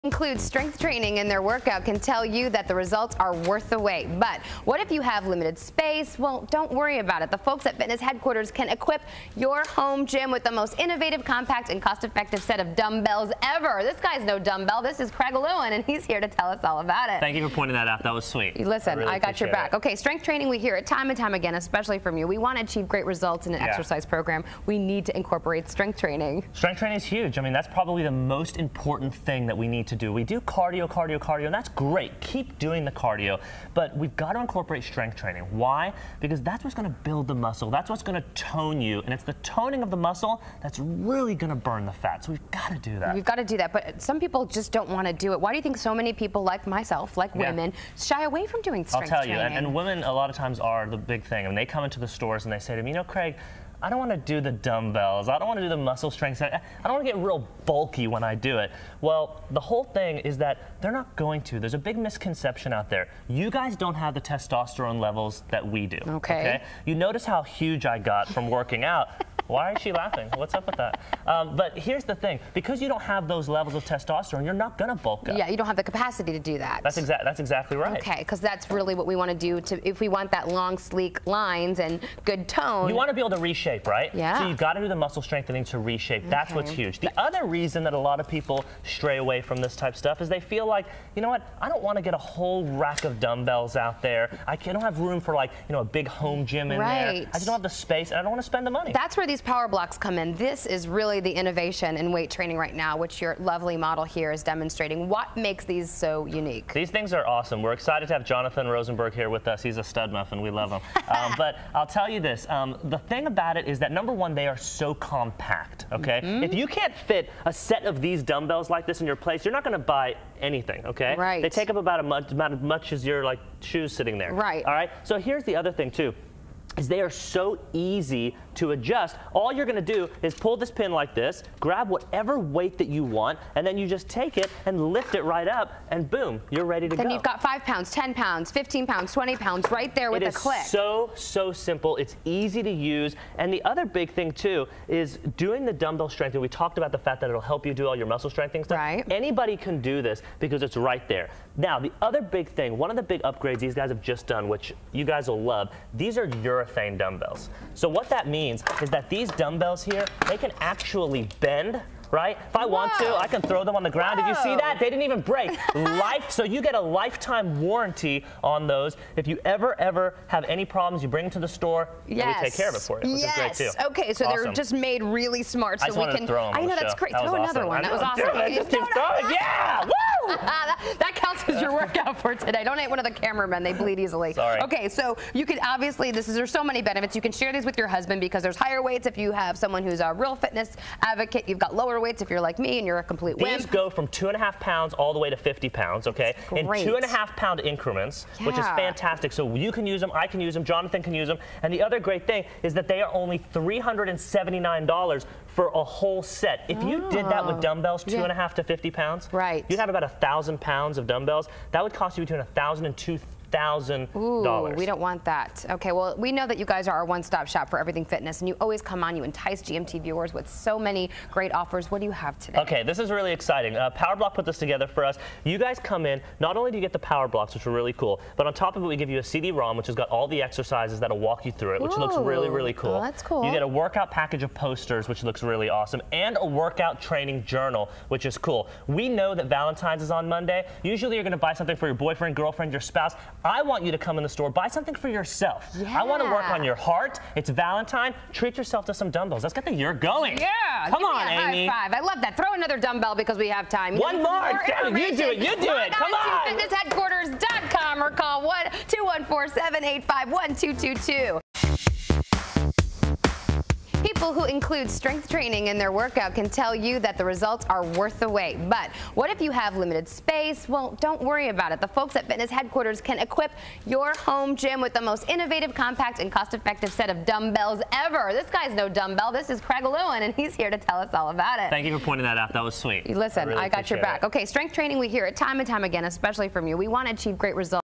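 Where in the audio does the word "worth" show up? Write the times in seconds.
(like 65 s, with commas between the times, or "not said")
3 s, 267 s.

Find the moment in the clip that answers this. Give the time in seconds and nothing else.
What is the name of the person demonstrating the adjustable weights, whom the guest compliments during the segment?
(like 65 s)
108 s.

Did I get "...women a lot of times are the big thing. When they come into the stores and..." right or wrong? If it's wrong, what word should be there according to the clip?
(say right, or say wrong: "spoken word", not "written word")
right.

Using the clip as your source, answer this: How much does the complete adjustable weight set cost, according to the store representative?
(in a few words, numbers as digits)
$379.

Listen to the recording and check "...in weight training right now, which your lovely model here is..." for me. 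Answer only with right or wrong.
right.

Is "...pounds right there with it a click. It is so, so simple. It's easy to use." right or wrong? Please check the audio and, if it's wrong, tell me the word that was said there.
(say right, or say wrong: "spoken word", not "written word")
right.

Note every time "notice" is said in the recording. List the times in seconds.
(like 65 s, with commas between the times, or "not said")
66 s.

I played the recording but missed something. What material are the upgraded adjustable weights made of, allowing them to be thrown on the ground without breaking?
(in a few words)
urethane.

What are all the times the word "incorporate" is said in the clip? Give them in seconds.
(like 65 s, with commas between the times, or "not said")
25 s, 34 s.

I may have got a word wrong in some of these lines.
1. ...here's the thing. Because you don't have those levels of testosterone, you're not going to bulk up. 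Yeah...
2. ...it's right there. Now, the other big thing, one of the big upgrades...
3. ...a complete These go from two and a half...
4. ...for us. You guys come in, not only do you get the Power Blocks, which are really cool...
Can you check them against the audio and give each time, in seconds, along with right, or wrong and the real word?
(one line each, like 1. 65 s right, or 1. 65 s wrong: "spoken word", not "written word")
1. 71 s right
2. 150 s right
3. 192 s right
4. 224 s right.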